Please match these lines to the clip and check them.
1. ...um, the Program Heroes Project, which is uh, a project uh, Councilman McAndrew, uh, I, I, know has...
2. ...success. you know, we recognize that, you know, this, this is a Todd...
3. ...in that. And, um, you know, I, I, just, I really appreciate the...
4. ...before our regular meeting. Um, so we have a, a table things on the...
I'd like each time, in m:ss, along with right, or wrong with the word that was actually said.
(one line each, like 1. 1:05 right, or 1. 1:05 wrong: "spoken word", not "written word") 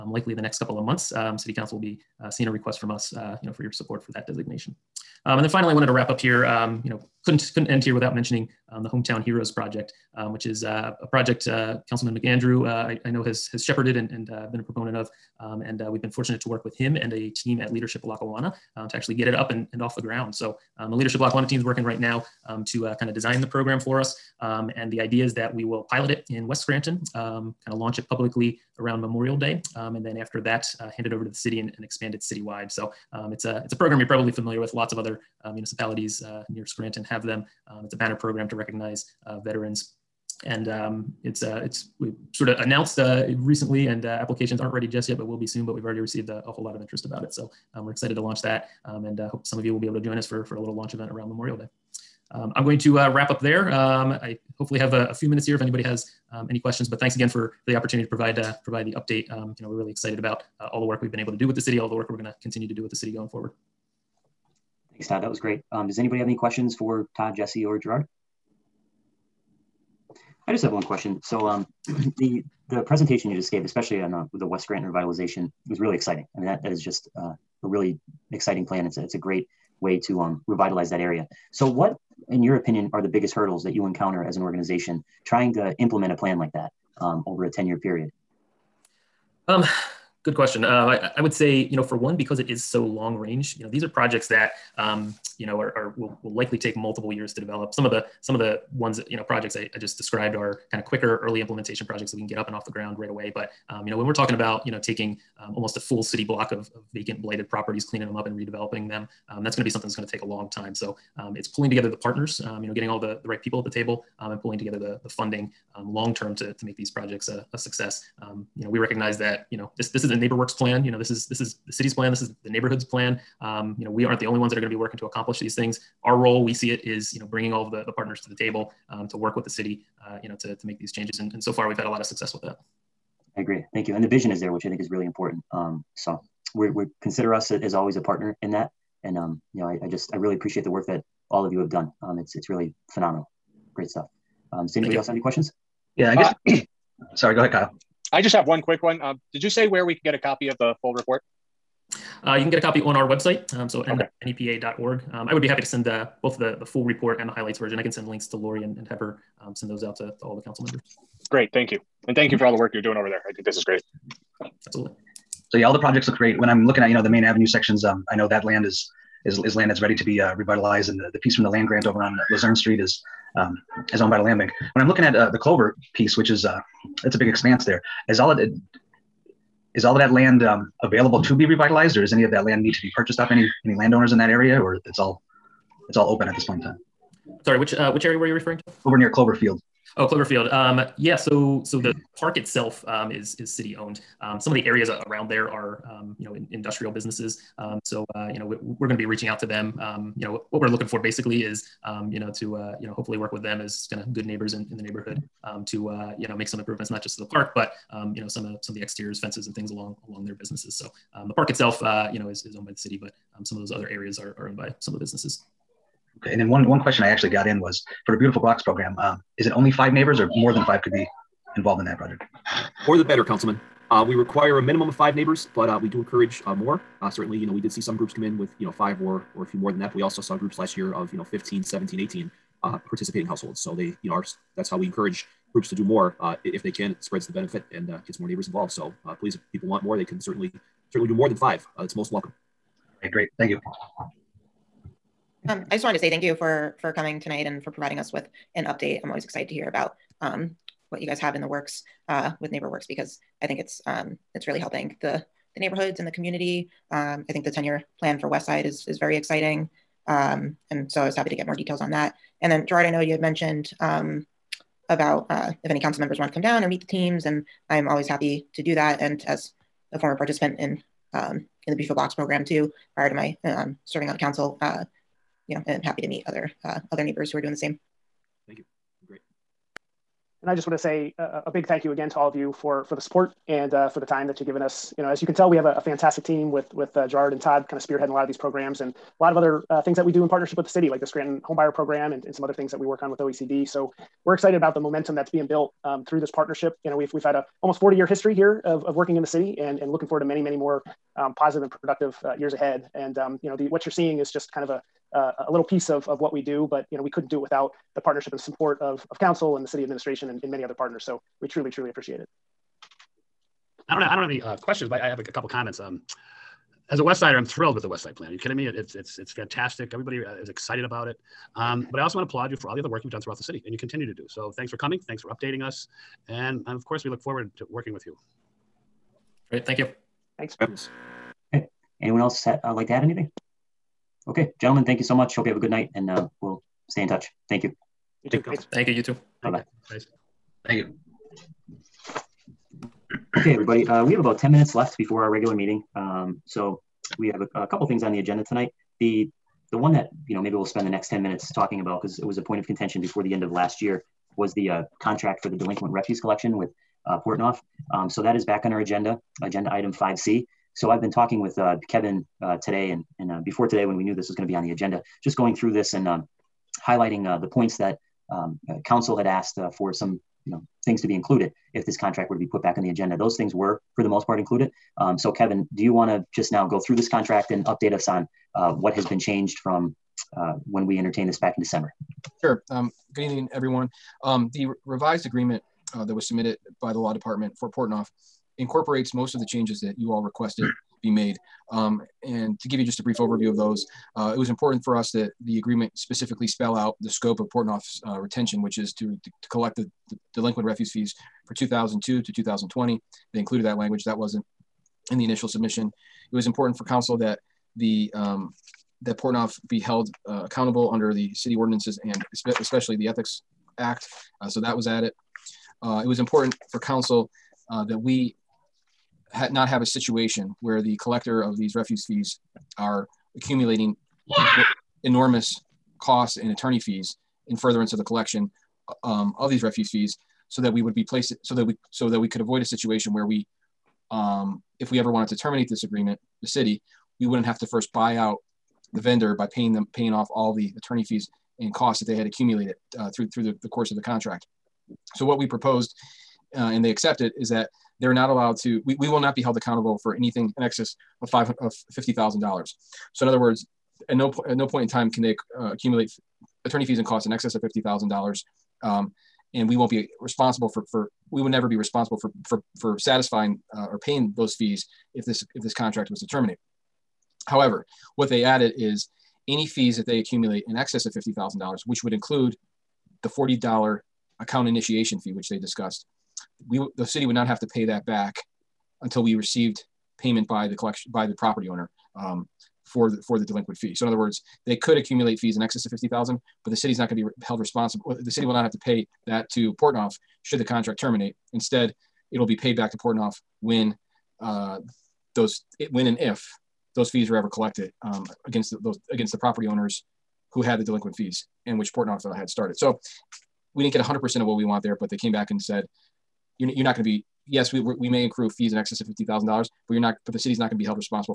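1. 0:08 wrong: "Hometown", not "Program"
2. 1:57 wrong: "NeighborWorks", not "Todd"
3. 2:18 right
4. 5:44 wrong: "couple", not "table".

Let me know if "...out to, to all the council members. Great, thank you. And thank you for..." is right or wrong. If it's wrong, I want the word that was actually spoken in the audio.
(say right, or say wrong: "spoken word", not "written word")
right.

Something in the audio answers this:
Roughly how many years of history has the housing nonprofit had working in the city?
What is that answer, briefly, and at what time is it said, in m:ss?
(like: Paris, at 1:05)
40 years, at 4:57.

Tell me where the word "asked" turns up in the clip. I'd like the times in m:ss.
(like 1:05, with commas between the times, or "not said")
6:09.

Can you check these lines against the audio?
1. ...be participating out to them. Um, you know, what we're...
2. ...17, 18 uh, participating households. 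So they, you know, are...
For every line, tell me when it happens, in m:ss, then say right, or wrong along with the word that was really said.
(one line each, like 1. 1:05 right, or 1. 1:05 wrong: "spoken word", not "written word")
1. 3:18 wrong: "reaching", not "participating"
2. 3:51 right.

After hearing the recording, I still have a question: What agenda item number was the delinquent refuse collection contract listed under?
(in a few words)
5C.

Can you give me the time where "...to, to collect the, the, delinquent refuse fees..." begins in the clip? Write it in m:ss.
6:39.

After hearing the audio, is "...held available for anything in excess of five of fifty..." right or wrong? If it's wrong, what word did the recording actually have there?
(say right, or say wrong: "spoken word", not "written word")
wrong: "accountable", not "available".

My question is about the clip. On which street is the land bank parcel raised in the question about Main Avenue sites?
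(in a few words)
Luzerne Street.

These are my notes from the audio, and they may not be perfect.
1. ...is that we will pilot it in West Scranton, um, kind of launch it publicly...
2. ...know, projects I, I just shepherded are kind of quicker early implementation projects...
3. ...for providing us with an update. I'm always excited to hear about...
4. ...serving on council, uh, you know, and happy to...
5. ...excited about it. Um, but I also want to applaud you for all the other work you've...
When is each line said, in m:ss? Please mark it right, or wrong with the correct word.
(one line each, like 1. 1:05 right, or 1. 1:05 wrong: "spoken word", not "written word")
1. 0:25 right
2. 1:39 wrong: "described", not "shepherded"
3. 4:07 right
4. 4:33 right
5. 5:20 right.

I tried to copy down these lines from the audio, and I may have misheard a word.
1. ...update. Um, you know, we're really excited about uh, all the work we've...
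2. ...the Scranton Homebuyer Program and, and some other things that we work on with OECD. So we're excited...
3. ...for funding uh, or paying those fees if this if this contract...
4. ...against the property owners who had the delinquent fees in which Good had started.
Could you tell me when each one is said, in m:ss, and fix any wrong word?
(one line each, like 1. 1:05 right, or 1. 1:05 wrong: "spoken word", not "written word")
1. 0:58 right
2. 4:51 right
3. 7:42 wrong: "satisfying", not "funding"
4. 8:19 wrong: "Portnoff", not "Good".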